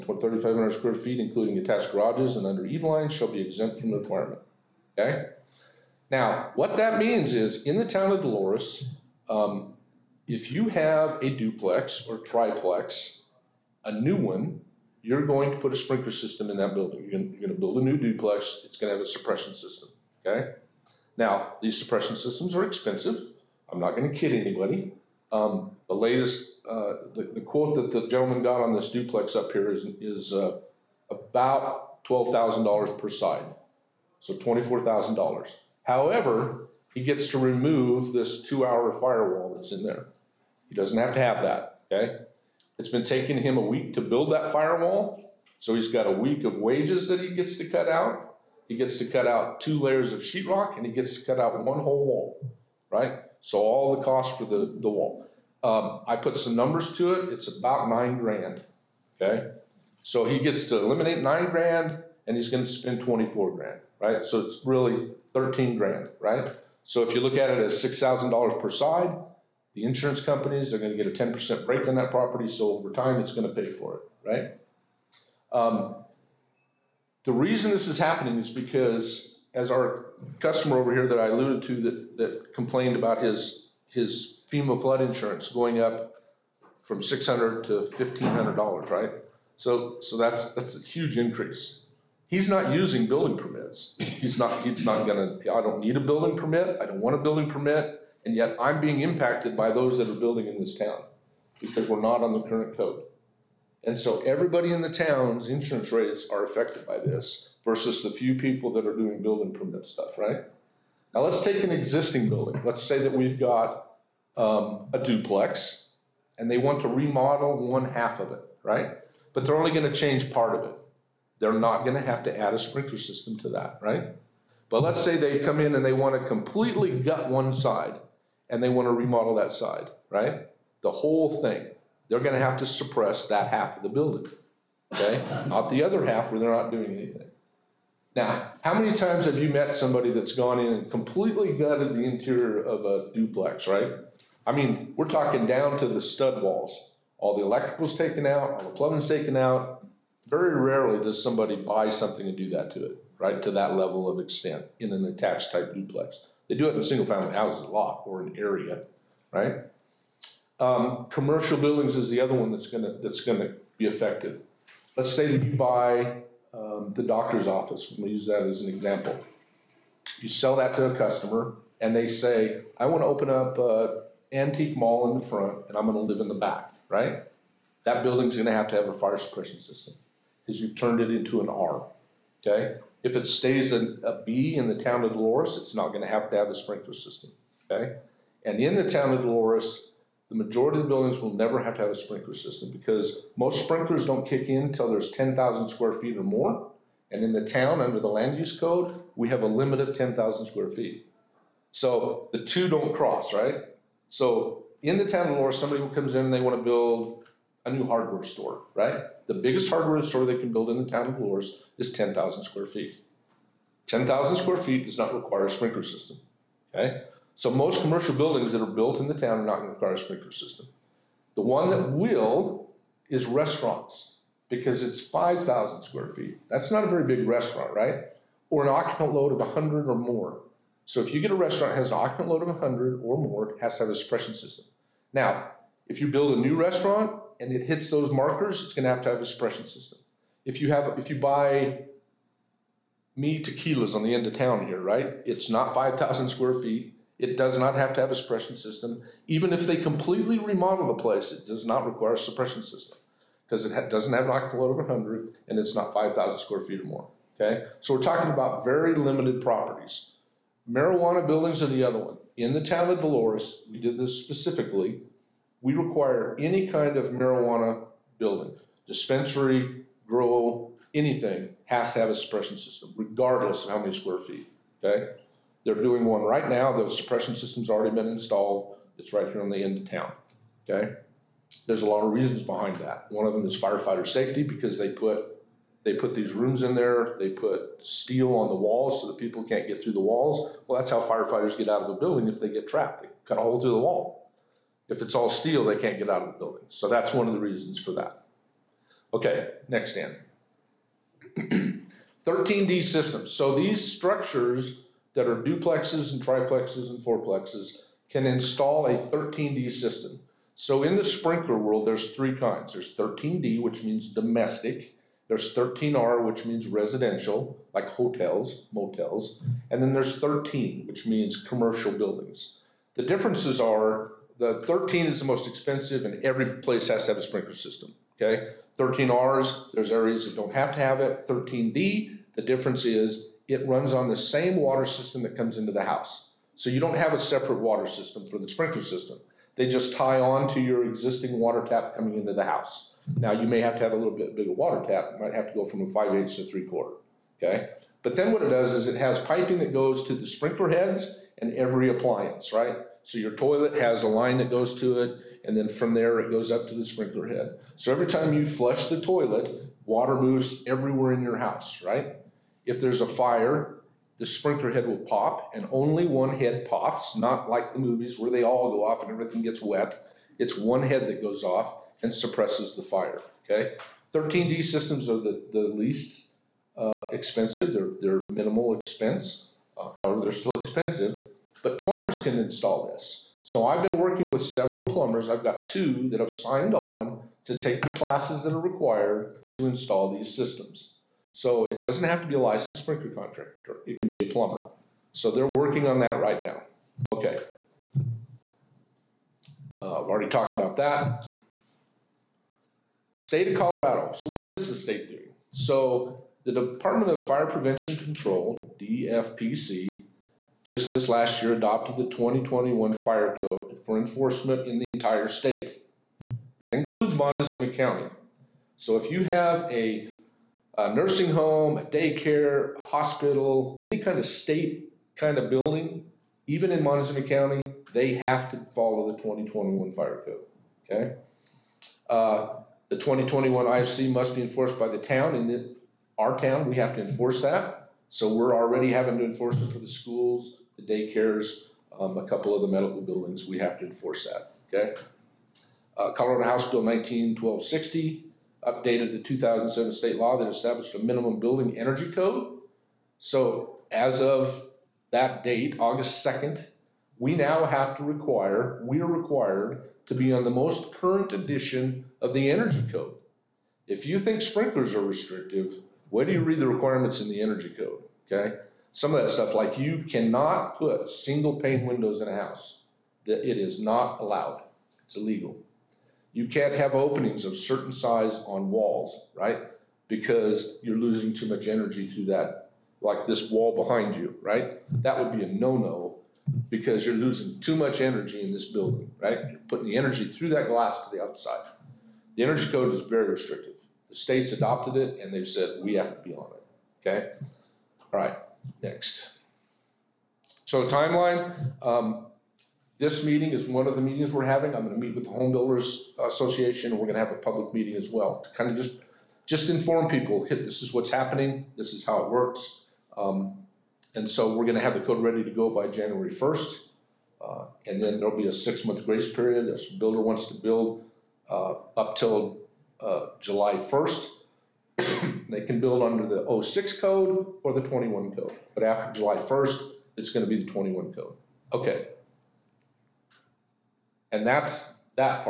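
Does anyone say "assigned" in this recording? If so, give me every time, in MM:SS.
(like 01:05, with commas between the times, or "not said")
not said.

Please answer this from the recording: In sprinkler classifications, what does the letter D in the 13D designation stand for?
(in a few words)
Domestic.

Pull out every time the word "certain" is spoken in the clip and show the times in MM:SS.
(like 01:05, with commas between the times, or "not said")
07:57.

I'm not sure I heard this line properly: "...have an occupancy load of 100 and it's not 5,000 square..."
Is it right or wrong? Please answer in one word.
right.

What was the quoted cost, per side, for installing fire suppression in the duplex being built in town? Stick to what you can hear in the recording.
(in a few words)
$12,000.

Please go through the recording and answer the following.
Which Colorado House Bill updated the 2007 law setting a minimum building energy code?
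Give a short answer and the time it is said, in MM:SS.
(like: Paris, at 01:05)
House Bill 1260, at 07:26.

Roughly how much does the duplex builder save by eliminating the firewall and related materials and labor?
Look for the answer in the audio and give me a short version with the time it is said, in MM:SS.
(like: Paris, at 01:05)
$9,000, at 00:57.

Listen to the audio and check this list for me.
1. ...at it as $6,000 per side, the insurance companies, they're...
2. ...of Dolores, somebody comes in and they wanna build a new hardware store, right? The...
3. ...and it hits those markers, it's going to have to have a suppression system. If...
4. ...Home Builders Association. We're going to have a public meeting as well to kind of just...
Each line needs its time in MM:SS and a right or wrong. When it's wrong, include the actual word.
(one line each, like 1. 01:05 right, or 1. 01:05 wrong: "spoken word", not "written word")
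1. 01:07 right
2. 03:25 right
3. 03:57 right
4. 08:25 right.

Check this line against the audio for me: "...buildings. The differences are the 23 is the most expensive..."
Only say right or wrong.
wrong.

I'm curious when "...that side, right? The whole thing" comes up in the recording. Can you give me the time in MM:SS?
02:09.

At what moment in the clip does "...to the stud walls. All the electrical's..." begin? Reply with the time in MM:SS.
02:25.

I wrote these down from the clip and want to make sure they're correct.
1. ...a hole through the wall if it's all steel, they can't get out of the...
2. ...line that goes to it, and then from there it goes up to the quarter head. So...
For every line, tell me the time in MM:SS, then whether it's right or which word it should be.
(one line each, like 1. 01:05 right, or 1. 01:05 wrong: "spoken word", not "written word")
1. 04:53 right
2. 05:54 wrong: "sprinkler", not "quarter".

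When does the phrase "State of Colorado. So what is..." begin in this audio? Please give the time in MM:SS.
06:43.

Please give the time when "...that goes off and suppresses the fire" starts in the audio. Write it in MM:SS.
06:11.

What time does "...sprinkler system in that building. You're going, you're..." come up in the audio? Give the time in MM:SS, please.
00:15.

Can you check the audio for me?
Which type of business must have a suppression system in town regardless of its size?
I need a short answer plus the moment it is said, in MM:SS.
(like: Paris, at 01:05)
Marijuana buildings, at 04:20.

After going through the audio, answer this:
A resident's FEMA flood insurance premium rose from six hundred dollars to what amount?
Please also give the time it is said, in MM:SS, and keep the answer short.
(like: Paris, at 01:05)
$1,500, at 01:27.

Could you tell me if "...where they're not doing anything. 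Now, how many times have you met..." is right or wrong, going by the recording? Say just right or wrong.
right.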